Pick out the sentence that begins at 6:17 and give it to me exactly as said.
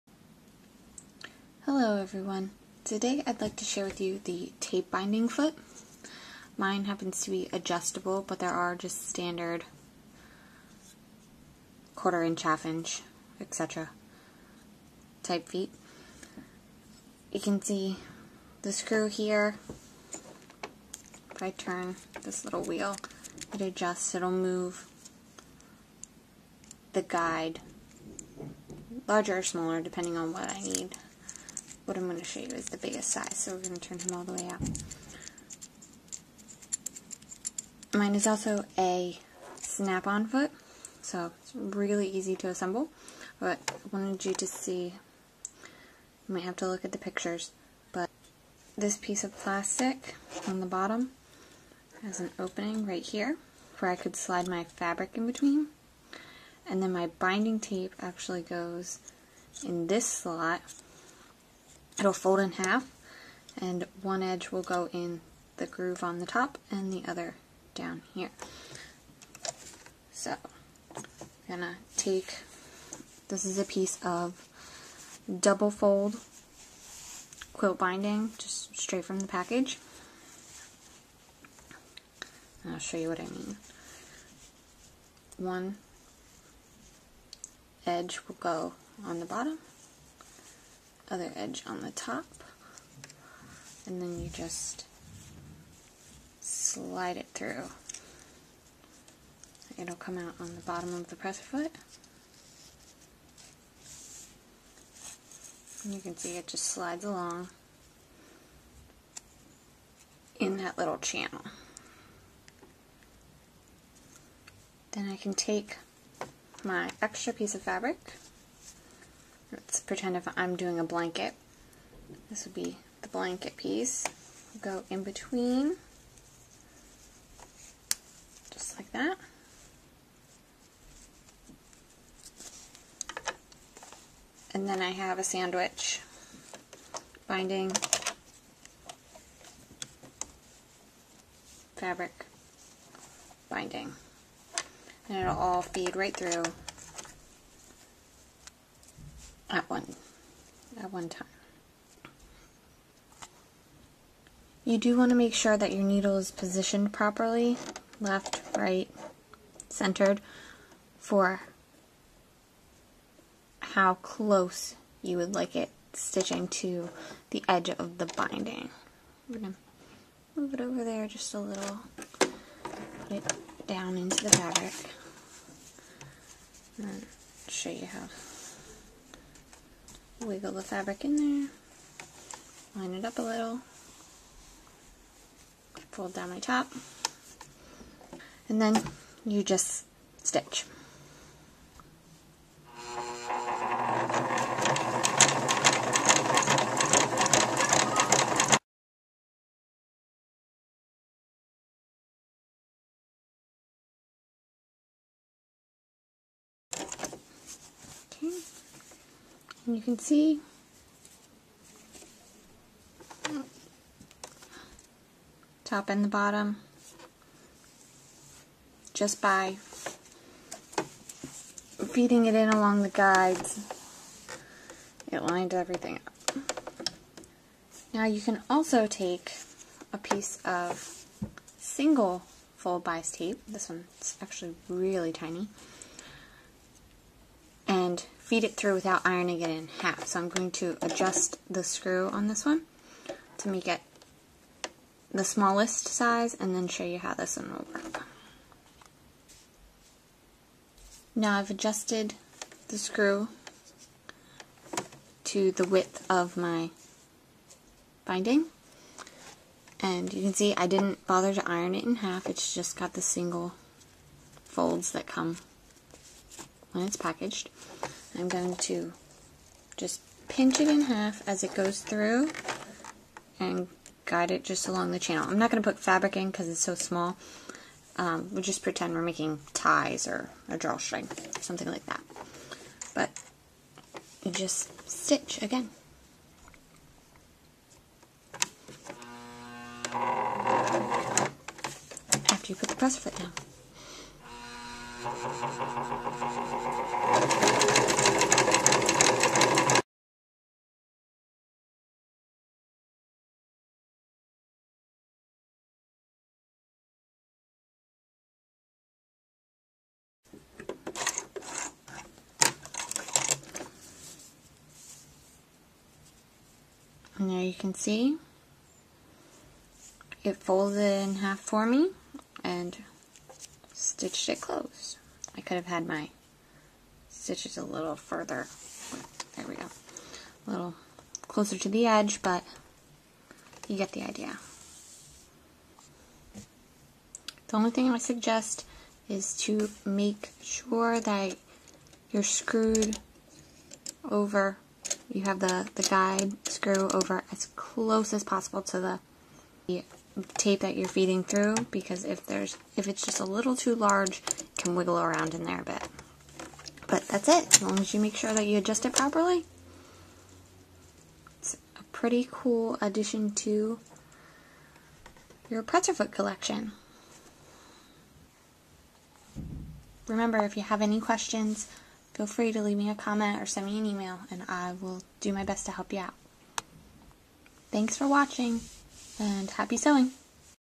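Thanks for watching, and happy sewing!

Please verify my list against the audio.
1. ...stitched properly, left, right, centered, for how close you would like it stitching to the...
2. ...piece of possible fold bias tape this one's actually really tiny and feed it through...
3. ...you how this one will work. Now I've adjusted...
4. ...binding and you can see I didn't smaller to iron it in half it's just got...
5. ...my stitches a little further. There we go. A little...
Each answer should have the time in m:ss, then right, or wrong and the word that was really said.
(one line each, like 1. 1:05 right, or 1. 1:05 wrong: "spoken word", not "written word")
1. 2:36 wrong: "positioned", not "stitched"
2. 3:49 wrong: "single", not "possible"
3. 4:06 right
4. 4:18 wrong: "bother", not "smaller"
5. 5:25 right.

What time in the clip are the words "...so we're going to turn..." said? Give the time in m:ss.
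0:33.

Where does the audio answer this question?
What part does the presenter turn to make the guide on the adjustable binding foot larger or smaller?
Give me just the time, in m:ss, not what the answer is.
0:22.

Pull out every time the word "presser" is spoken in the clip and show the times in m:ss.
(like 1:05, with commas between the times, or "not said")
1:41, 4:52, 6:05.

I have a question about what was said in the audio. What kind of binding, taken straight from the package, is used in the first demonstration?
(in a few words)
double fold quilt binding.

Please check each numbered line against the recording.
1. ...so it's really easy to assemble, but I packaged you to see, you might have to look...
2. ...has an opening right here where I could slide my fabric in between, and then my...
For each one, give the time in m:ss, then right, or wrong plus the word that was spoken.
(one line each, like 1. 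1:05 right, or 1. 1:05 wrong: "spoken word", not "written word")
1. 0:41 wrong: "wanted", not "packaged"
2. 0:52 right.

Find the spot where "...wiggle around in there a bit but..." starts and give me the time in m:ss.
5:54.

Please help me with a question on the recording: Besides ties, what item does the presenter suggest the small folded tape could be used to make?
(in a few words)
a drawstring.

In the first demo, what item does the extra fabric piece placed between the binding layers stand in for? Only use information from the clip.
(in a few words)
a blanket.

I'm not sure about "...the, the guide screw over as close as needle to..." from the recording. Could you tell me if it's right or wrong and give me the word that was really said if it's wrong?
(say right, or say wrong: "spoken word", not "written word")
wrong: "possible", not "needle".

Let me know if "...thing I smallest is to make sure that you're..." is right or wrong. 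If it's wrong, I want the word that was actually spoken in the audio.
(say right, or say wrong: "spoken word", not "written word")
wrong: "suggest", not "smallest".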